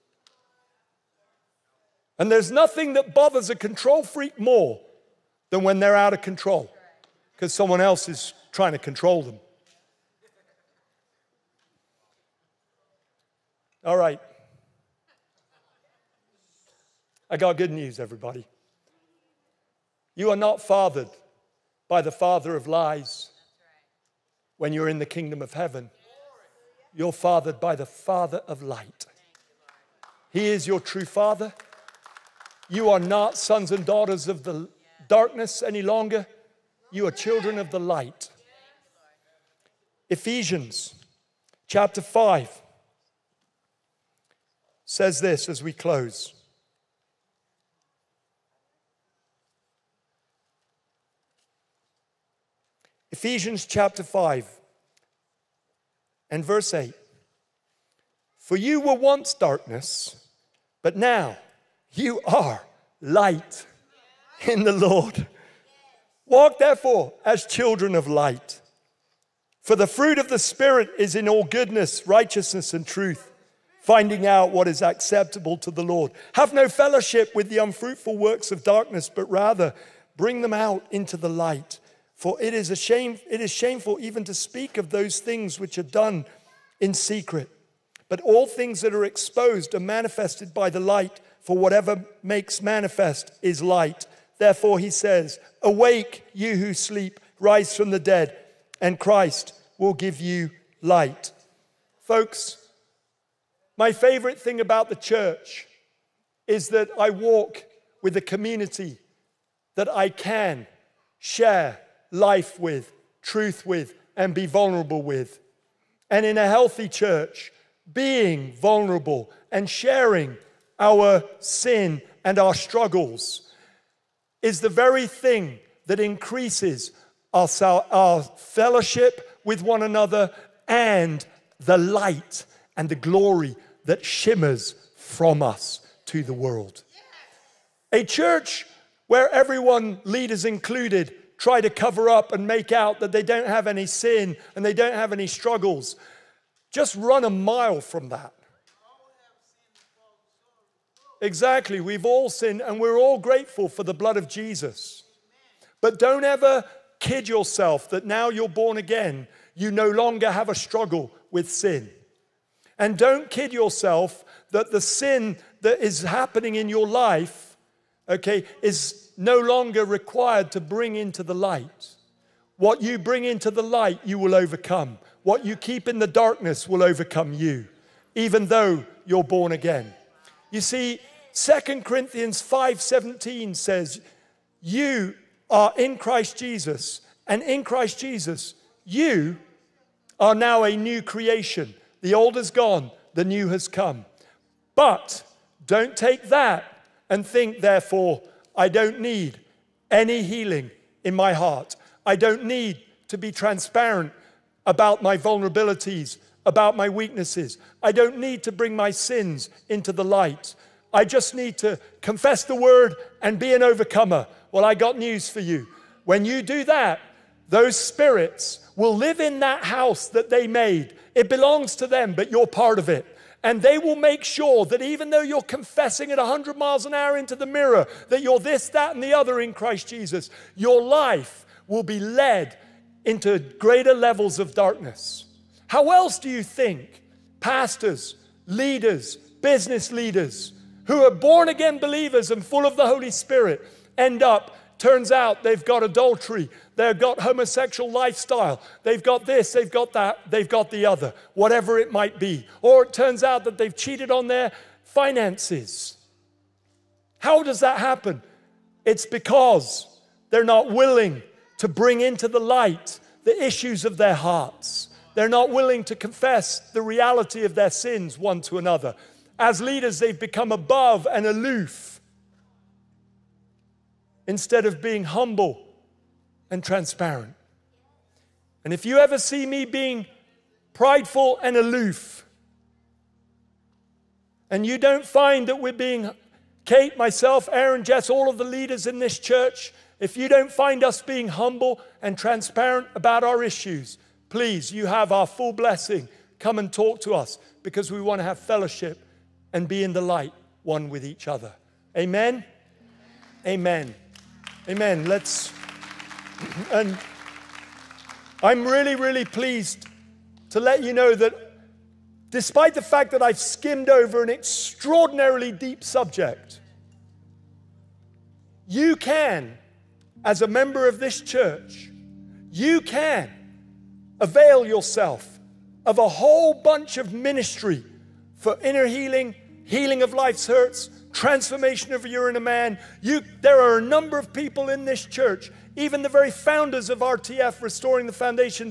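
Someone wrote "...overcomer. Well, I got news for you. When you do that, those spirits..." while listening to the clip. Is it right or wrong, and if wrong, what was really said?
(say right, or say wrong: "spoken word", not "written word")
right.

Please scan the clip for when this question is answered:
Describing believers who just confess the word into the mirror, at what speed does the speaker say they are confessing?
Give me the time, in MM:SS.
03:46.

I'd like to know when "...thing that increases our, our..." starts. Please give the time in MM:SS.
02:05.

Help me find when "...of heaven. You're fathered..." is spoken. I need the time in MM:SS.
00:25.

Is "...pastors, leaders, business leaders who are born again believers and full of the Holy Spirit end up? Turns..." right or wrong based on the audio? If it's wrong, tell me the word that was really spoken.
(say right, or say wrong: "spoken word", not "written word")
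right.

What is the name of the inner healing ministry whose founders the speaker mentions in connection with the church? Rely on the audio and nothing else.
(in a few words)
Restoring the Foundations.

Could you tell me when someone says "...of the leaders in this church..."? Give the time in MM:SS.
04:48.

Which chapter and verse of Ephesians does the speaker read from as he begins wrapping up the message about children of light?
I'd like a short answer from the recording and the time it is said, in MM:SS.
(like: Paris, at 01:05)
Chapter 5, verse 8, at 00:53.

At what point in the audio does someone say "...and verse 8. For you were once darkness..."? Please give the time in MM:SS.
00:56.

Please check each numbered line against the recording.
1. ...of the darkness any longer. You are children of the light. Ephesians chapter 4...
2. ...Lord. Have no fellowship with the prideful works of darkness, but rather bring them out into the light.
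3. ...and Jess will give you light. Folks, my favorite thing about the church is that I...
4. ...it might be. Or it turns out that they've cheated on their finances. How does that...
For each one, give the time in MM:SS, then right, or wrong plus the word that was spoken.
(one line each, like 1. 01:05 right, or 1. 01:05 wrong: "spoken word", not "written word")
1. 00:34 wrong: "5", not "4"
2. 01:15 wrong: "unfruitful", not "prideful"
3. 01:38 wrong: "Christ", not "Jess"
4. 04:11 right.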